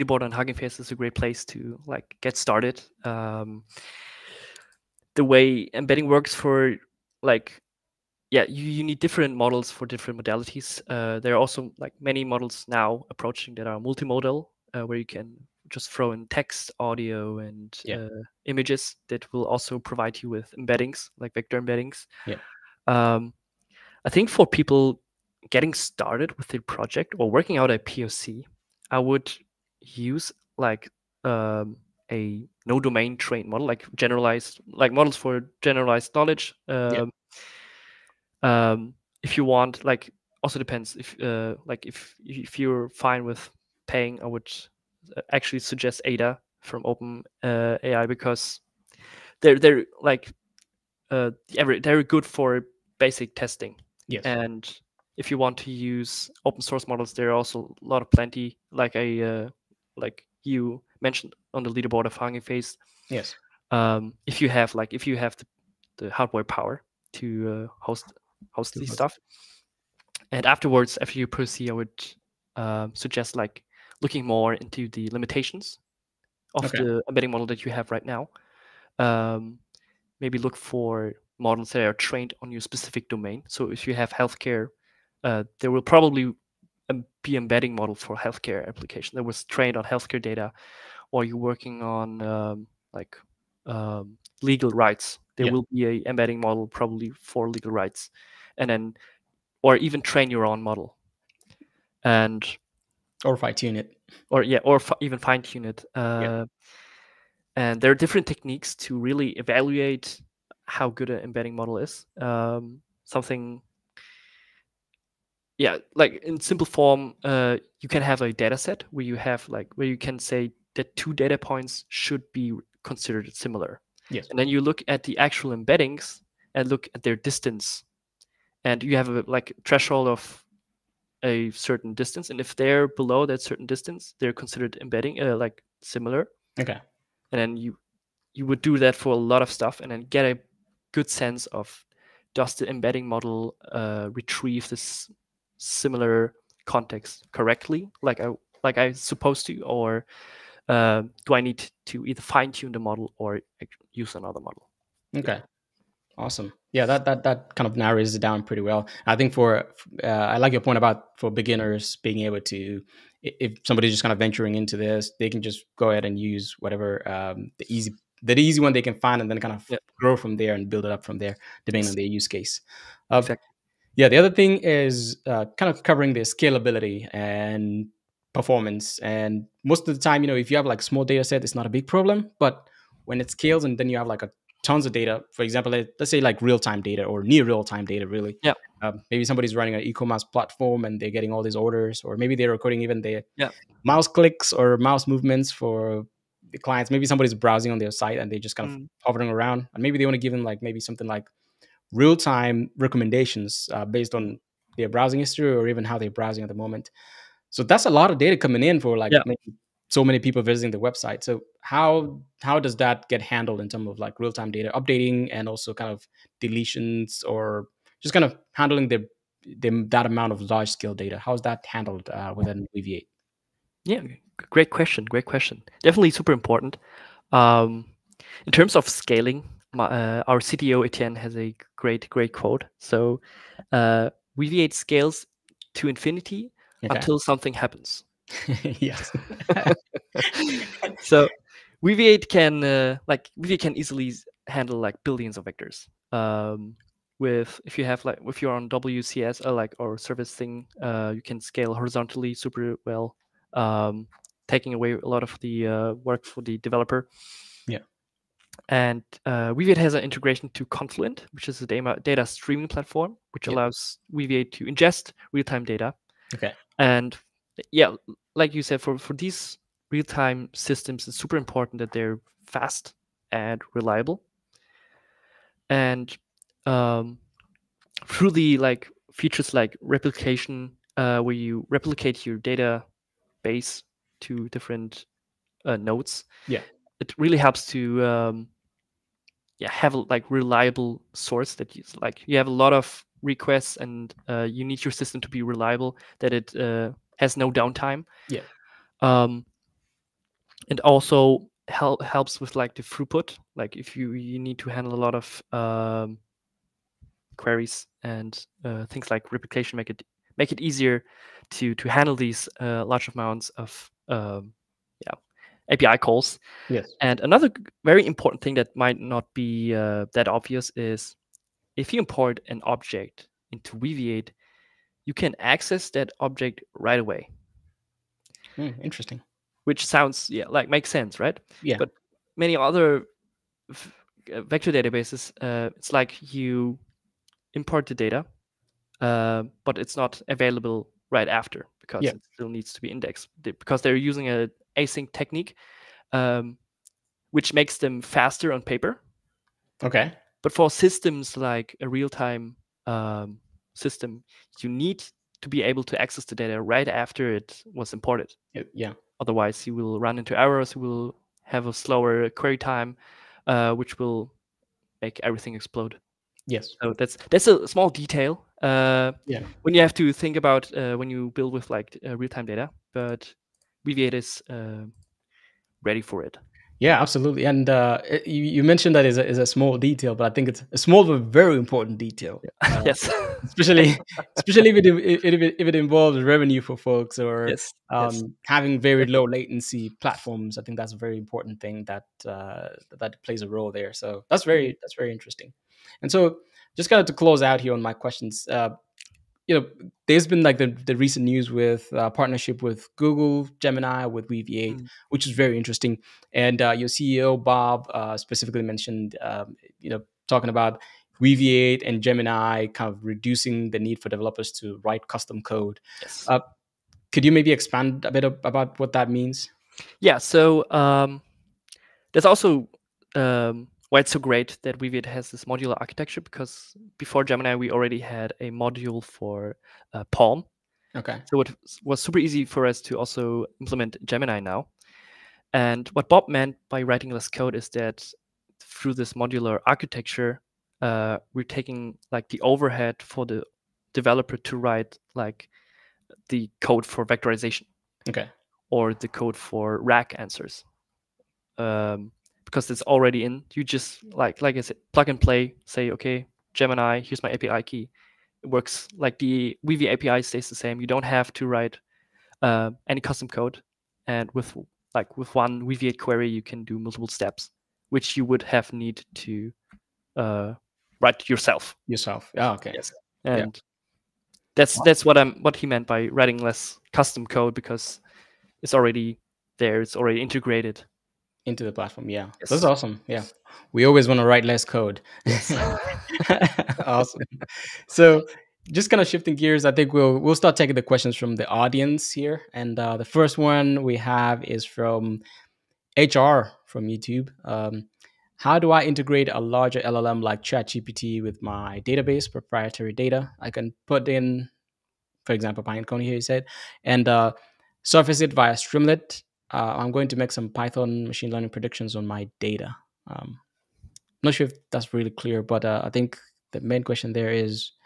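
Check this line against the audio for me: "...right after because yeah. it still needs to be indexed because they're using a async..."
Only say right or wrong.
right.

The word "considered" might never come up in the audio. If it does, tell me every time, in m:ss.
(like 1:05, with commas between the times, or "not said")
2:02, 2:14.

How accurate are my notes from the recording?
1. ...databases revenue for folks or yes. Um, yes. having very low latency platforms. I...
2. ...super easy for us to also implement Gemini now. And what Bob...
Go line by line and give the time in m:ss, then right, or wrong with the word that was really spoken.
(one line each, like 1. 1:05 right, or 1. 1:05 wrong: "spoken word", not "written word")
1. 6:25 wrong: "involves", not "databases"
2. 7:12 right.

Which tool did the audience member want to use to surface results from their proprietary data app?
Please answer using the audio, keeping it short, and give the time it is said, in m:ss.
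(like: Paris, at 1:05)
Streamlit, at 8:28.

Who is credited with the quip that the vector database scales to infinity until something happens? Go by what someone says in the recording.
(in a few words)
Etienne.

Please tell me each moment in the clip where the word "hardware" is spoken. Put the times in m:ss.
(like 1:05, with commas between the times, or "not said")
1:06.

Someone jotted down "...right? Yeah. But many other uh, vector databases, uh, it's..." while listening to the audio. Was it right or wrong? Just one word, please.
right.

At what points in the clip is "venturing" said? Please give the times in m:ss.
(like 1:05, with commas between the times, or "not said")
2:44.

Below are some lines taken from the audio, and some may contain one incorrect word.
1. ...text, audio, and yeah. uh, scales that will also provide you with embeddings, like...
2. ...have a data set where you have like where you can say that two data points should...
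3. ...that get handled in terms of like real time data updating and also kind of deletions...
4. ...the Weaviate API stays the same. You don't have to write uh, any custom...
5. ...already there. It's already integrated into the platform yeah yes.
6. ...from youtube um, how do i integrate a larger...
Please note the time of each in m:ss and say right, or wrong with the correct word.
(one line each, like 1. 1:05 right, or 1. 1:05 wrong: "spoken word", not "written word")
1. 0:16 wrong: "images", not "scales"
2. 1:58 right
3. 3:32 right
4. 7:39 right
5. 7:58 right
6. 8:16 right.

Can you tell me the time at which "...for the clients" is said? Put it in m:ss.
3:15.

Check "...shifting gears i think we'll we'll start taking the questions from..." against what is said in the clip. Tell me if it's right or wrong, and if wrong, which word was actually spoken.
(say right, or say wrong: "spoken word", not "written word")
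right.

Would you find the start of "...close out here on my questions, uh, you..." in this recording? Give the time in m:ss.
6:37.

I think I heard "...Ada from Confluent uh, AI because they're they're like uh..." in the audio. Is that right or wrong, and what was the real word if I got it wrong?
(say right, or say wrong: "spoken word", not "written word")
wrong: "Open", not "Confluent".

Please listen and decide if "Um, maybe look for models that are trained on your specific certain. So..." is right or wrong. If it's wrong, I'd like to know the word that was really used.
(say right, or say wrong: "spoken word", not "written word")
wrong: "domain", not "certain".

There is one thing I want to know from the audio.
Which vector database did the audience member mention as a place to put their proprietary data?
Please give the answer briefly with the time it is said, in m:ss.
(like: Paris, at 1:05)
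Pinecone, at 8:25.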